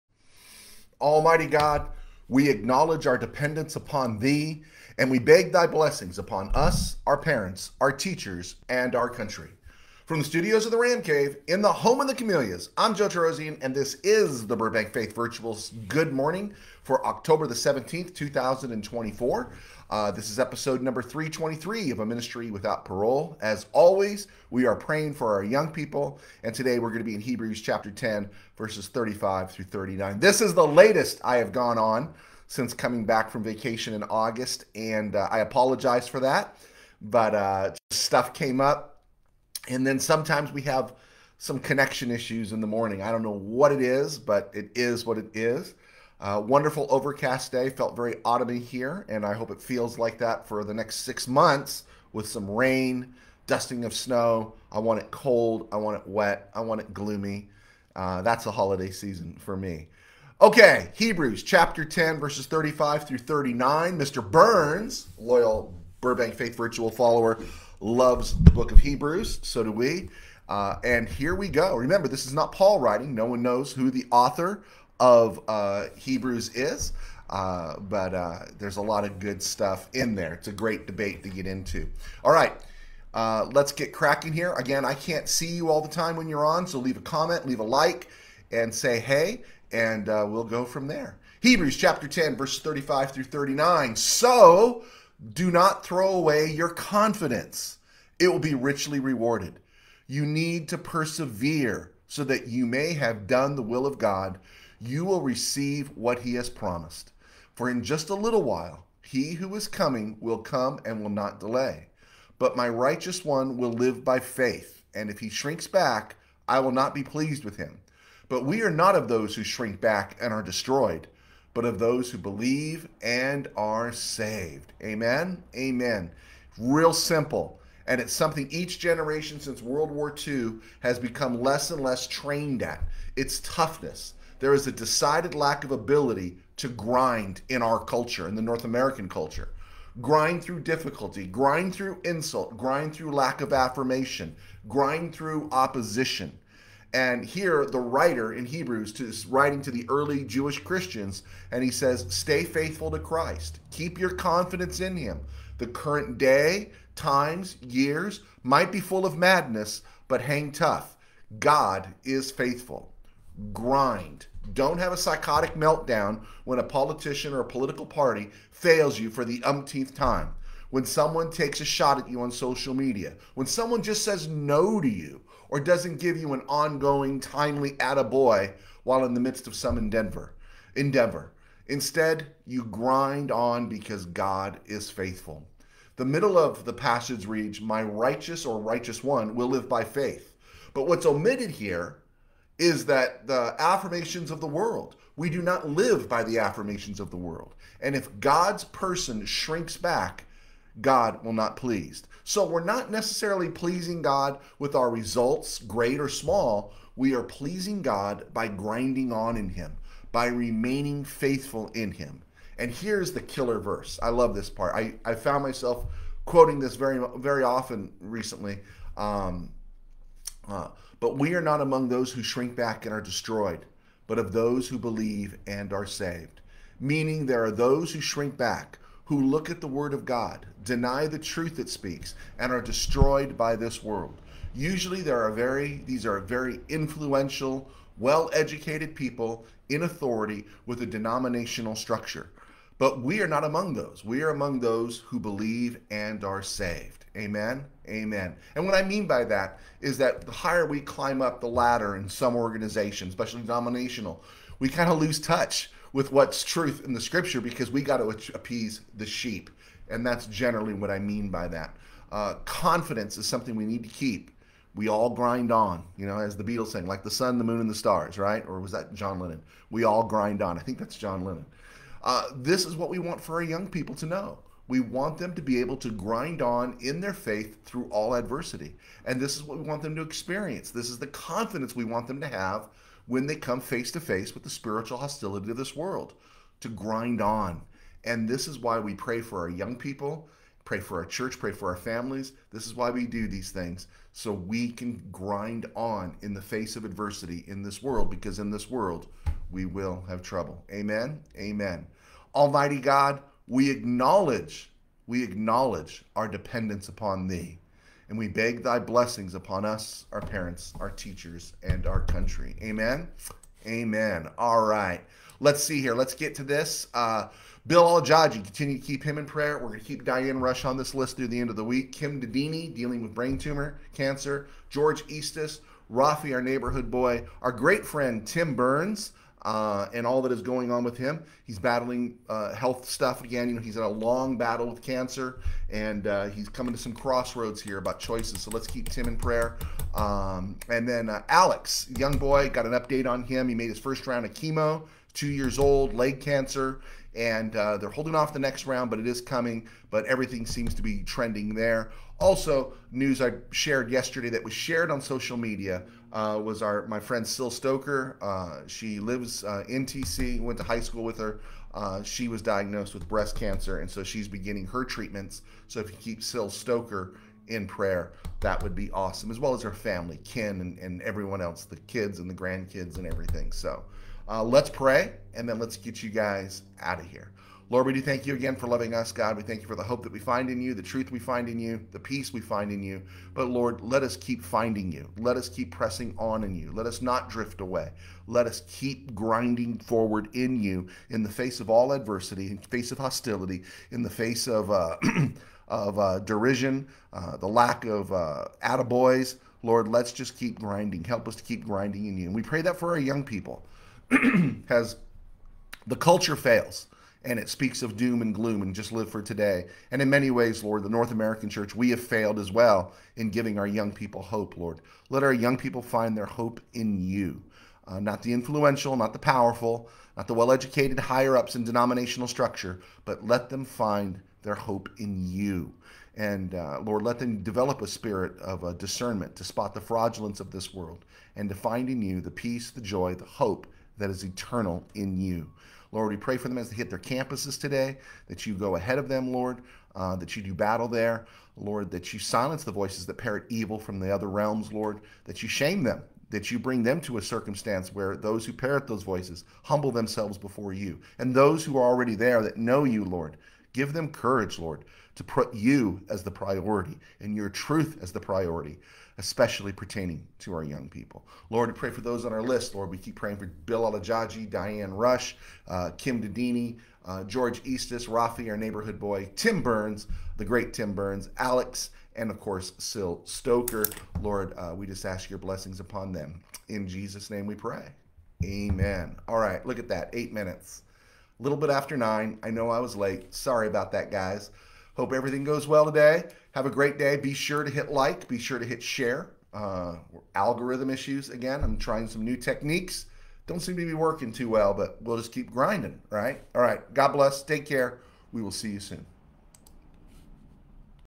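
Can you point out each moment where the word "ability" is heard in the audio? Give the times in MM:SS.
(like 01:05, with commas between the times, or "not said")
02:15.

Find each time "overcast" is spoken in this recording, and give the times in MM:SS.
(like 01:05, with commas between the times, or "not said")
00:46.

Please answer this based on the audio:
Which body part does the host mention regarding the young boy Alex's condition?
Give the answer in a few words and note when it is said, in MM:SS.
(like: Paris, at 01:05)
leg, at 05:45.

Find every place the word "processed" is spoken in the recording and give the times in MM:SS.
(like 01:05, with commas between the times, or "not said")
not said.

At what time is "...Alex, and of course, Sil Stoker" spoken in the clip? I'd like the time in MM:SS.
07:51.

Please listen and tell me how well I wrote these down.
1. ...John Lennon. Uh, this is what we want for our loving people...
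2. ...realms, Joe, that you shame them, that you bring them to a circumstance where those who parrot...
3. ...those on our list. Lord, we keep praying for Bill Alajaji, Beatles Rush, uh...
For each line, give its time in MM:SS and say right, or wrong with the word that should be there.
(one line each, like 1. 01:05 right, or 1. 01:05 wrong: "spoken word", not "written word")
1. 04:30 wrong: "young", not "loving"
2. 07:24 wrong: "Lord", not "Joe"
3. 07:42 wrong: "Diane", not "Beatles".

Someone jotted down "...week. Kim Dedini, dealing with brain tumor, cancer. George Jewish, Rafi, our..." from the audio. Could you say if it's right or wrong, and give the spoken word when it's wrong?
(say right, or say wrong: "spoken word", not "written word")
wrong: "Eastus", not "Jewish".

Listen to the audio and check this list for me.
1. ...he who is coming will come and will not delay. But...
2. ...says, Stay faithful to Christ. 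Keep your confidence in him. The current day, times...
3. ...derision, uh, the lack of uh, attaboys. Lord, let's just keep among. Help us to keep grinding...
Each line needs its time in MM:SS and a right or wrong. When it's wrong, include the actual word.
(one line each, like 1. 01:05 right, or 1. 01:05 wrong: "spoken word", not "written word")
1. 01:49 right
2. 02:31 right
3. 06:36 wrong: "grinding", not "among".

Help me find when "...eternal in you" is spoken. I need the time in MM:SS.
07:14.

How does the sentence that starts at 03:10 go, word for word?
But what's omitted here is that the affirmations of the world, we do not live by the affirmations of the world.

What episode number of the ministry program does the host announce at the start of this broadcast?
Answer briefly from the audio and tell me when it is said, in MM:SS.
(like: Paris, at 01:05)
323, at 00:20.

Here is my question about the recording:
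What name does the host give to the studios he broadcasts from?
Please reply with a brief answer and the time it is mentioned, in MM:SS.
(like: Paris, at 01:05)
the Ram Cave, at 00:10.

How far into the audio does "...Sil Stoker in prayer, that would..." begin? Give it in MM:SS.
06:06.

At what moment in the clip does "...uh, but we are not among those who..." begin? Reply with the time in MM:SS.
03:40.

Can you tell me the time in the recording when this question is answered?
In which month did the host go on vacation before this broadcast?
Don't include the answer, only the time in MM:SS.
00:34.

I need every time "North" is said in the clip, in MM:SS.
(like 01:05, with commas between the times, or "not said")
02:18, 06:50.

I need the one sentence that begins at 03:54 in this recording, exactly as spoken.
Usually, there are very these are very influential, well-educated people in authority with a denominational structure.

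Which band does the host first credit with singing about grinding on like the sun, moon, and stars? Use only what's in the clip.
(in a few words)
the Beatles.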